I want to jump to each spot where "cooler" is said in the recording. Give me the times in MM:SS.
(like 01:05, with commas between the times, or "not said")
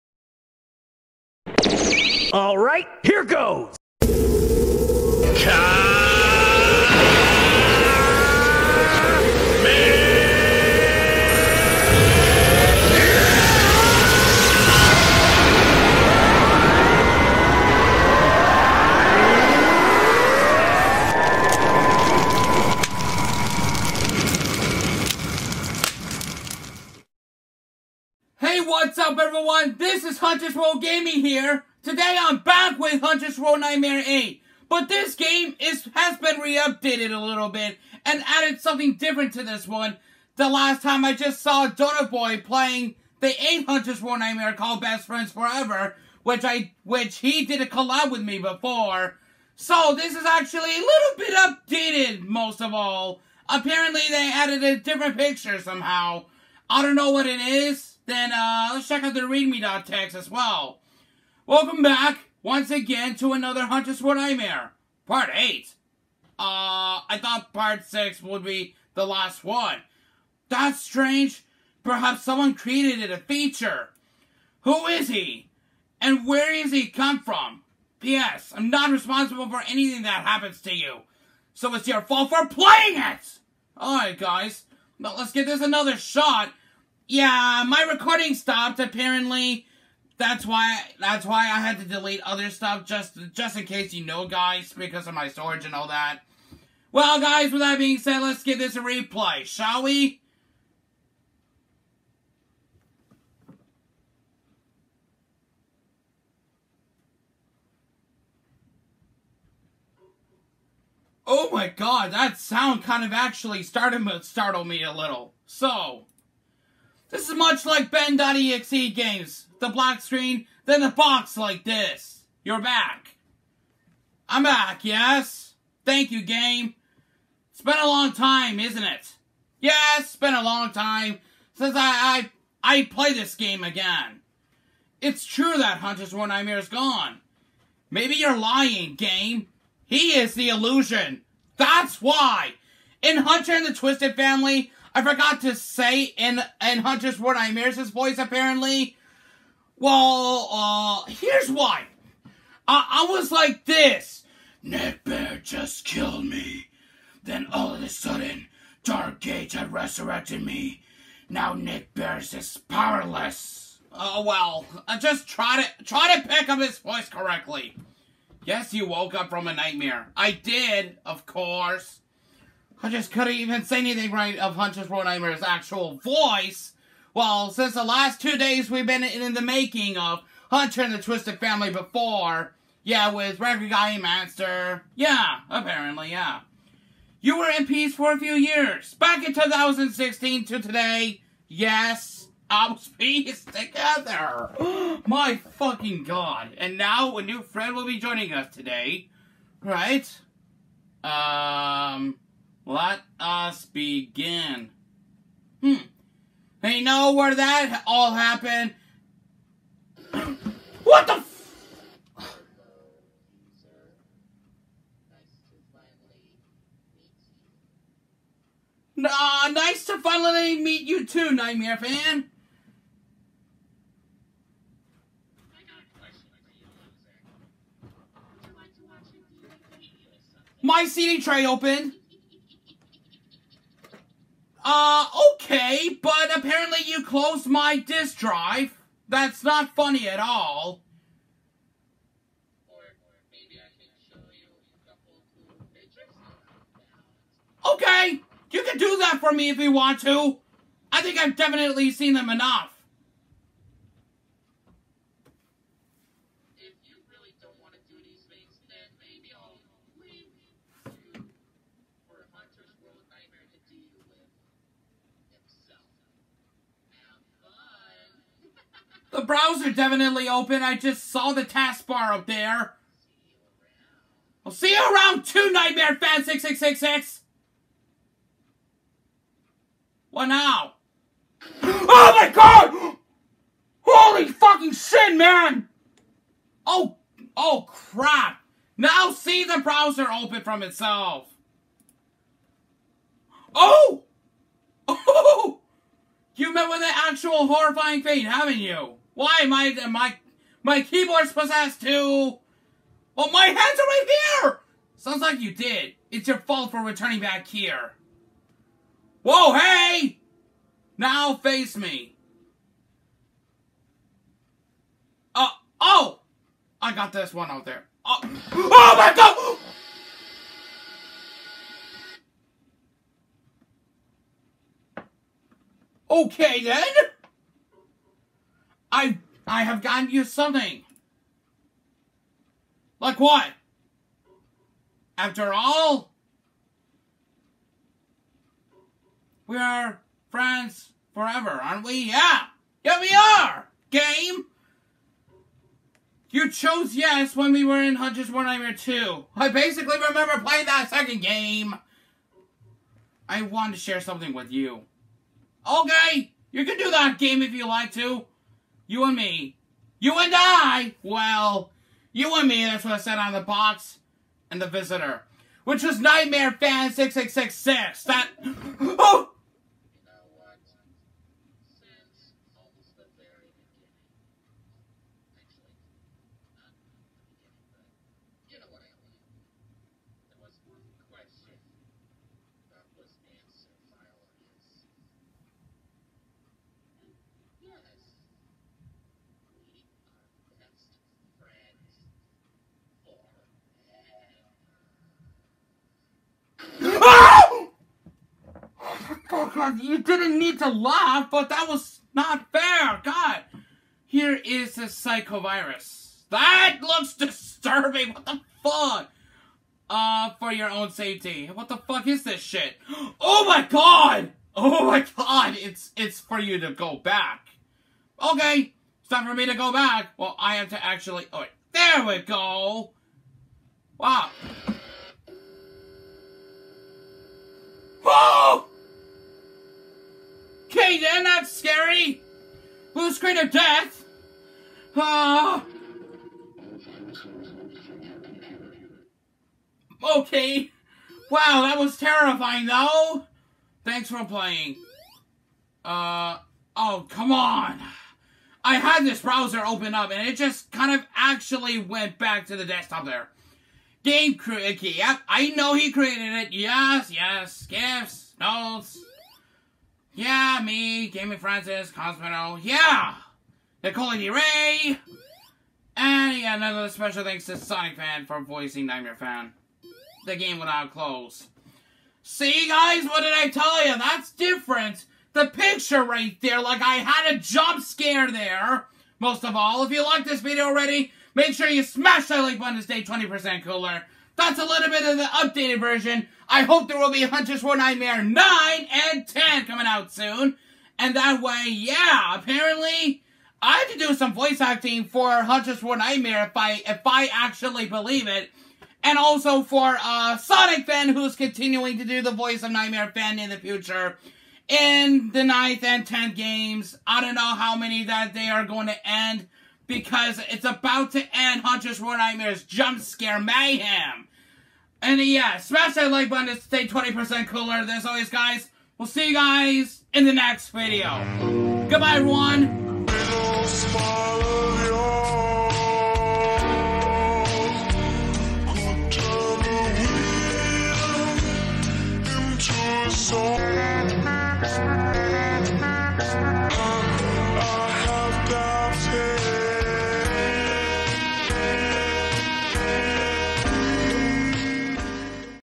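08:03, 08:37.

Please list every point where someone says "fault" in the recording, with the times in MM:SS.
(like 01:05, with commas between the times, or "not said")
01:22, 05:06.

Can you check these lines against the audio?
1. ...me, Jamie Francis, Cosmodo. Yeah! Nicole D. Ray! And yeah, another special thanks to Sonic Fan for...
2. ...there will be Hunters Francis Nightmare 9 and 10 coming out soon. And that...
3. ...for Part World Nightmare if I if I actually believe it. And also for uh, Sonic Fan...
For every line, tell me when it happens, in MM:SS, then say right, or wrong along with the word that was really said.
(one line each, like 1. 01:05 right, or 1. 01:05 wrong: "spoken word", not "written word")
1. 07:40 right
2. 08:06 wrong: "World", not "Francis"
3. 08:15 wrong: "Hunters", not "Part".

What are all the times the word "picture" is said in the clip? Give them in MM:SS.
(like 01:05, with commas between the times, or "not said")
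00:55, 07:55.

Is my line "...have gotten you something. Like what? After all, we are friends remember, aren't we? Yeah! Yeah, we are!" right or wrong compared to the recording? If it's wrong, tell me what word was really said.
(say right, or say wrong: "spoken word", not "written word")
wrong: "forever", not "remember".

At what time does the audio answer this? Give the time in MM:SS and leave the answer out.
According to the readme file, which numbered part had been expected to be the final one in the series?
01:07.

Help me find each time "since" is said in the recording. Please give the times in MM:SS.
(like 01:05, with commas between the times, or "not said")
02:11, 02:57.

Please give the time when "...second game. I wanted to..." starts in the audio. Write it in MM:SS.
05:50.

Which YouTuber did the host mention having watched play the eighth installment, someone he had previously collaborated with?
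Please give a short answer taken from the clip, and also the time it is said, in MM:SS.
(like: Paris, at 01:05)
Donutboy, at 00:41.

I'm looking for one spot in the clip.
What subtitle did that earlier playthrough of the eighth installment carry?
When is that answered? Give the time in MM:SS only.
00:44.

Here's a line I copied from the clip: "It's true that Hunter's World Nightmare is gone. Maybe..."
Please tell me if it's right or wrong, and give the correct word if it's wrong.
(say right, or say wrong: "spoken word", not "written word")
right.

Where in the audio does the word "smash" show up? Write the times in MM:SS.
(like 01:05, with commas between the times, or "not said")
08:01, 08:35.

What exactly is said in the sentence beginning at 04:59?
Why am I, my, my keyboard's possessed too?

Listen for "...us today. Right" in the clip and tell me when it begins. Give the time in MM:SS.
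03:18.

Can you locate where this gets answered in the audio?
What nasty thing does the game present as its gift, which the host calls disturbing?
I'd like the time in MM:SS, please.
06:44.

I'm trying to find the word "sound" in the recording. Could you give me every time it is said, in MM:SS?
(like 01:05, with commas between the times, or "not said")
01:52, 05:04.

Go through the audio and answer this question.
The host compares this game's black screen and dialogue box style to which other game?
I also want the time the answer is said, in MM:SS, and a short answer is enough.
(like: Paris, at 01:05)
Ben.exe, at 01:57.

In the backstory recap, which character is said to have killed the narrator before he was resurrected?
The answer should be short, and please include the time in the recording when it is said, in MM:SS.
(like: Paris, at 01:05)
Netbear, at 02:34.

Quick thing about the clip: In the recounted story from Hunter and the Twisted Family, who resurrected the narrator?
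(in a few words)
Dark Age.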